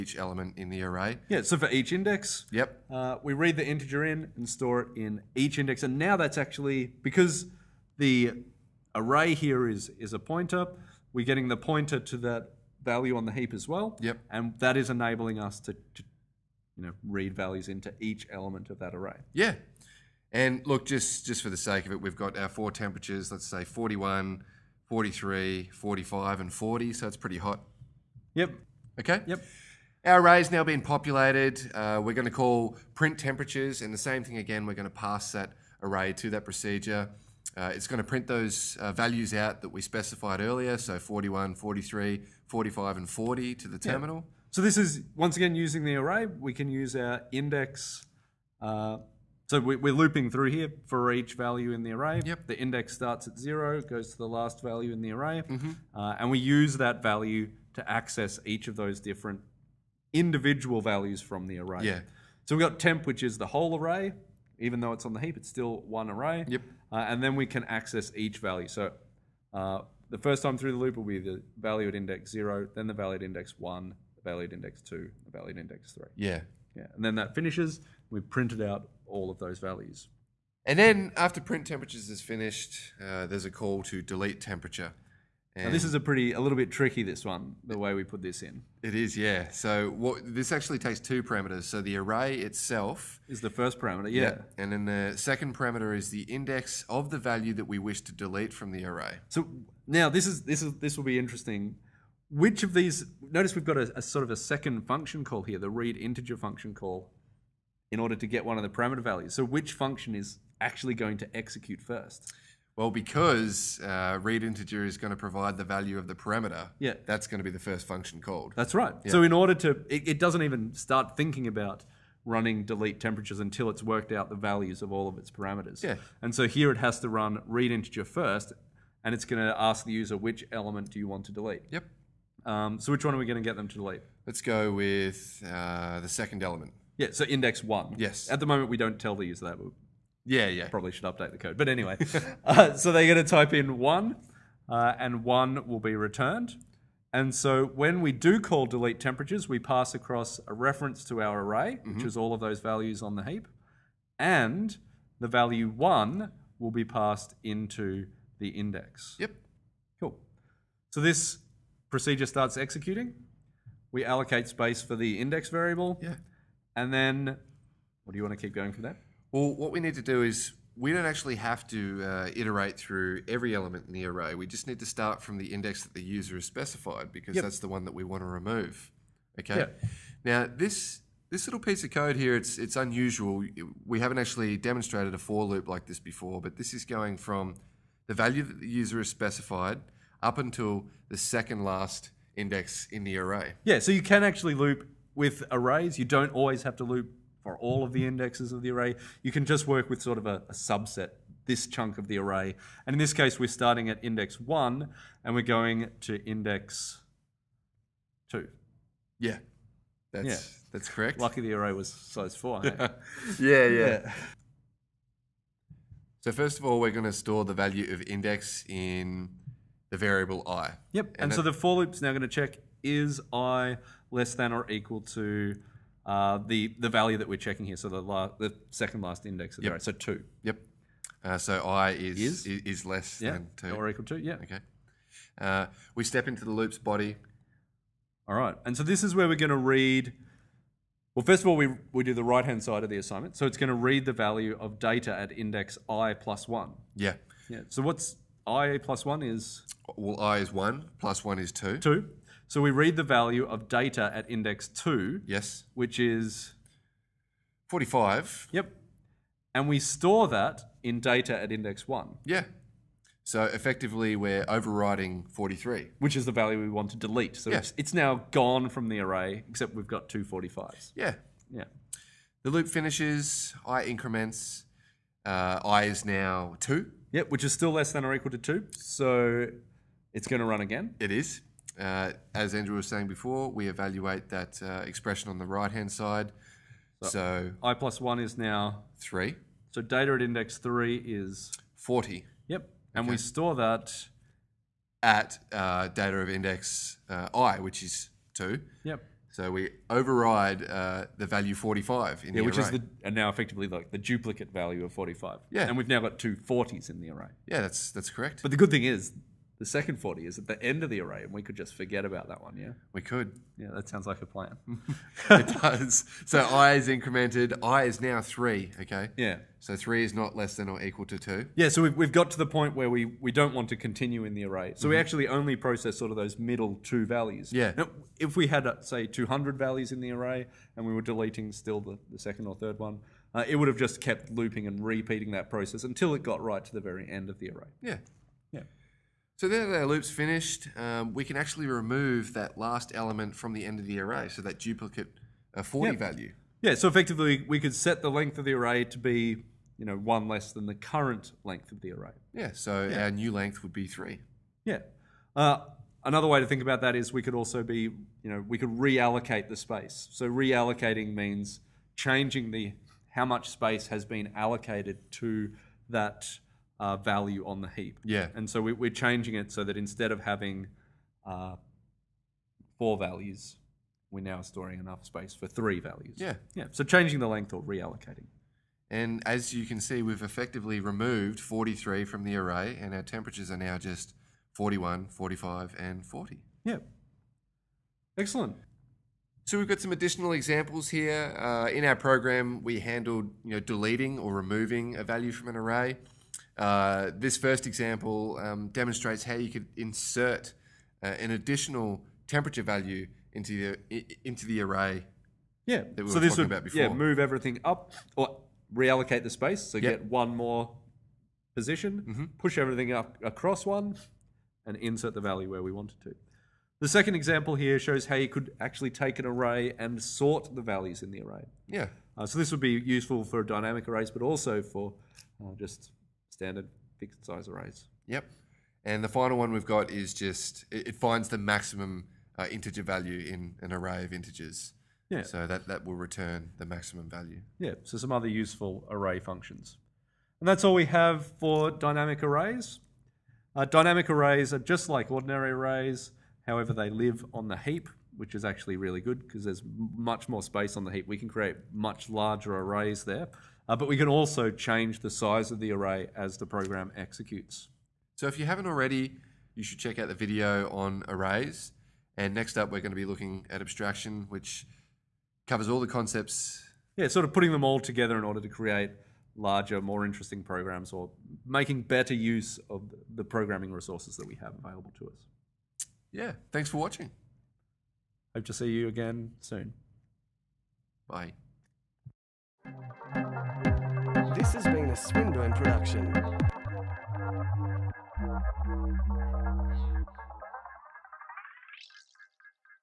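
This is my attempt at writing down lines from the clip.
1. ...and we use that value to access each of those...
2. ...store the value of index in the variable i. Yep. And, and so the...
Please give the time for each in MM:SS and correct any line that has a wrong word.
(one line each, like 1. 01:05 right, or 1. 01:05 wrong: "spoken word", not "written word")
1. 00:56 right
2. 03:37 right.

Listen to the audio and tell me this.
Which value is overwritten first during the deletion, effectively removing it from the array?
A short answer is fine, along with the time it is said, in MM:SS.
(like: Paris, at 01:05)
43, at 04:24.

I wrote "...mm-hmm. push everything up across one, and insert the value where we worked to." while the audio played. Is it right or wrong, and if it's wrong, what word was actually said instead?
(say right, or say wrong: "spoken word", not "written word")
wrong: "wanted", not "worked".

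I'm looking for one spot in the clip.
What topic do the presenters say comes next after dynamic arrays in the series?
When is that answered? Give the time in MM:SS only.
07:43.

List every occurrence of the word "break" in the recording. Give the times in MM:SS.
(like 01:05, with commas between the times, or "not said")
not said.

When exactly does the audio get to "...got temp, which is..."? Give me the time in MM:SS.
01:02.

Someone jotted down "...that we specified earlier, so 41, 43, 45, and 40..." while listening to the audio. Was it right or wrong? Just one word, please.
right.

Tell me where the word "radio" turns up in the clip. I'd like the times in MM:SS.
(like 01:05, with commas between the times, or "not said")
not said.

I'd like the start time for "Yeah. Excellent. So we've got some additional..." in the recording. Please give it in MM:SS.
06:26.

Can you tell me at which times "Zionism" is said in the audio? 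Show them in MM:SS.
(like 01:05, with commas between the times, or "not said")
not said.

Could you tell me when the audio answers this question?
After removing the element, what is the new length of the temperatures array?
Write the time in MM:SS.
05:53.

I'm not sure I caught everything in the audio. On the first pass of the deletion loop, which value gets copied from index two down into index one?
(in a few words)
45.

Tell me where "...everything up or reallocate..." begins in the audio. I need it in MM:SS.
06:47.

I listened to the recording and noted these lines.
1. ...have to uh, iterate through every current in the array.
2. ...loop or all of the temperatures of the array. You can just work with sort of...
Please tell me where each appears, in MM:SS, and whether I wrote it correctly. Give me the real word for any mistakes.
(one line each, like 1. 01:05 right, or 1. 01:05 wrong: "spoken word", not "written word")
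1. 02:51 wrong: "element", not "current"
2. 03:16 wrong: "indexes", not "temperatures".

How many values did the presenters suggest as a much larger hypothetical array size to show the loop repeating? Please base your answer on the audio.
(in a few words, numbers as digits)
200.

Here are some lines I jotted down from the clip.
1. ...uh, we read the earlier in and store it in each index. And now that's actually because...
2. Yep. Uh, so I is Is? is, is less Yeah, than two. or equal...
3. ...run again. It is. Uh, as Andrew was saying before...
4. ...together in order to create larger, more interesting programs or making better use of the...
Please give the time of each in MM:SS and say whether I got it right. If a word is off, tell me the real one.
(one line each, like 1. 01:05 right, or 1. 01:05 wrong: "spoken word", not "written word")
1. 00:02 wrong: "integer", not "earlier"
2. 03:50 right
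3. 04:40 right
4. 07:47 right.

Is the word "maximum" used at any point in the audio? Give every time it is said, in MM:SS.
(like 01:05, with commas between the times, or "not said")
07:11, 07:16.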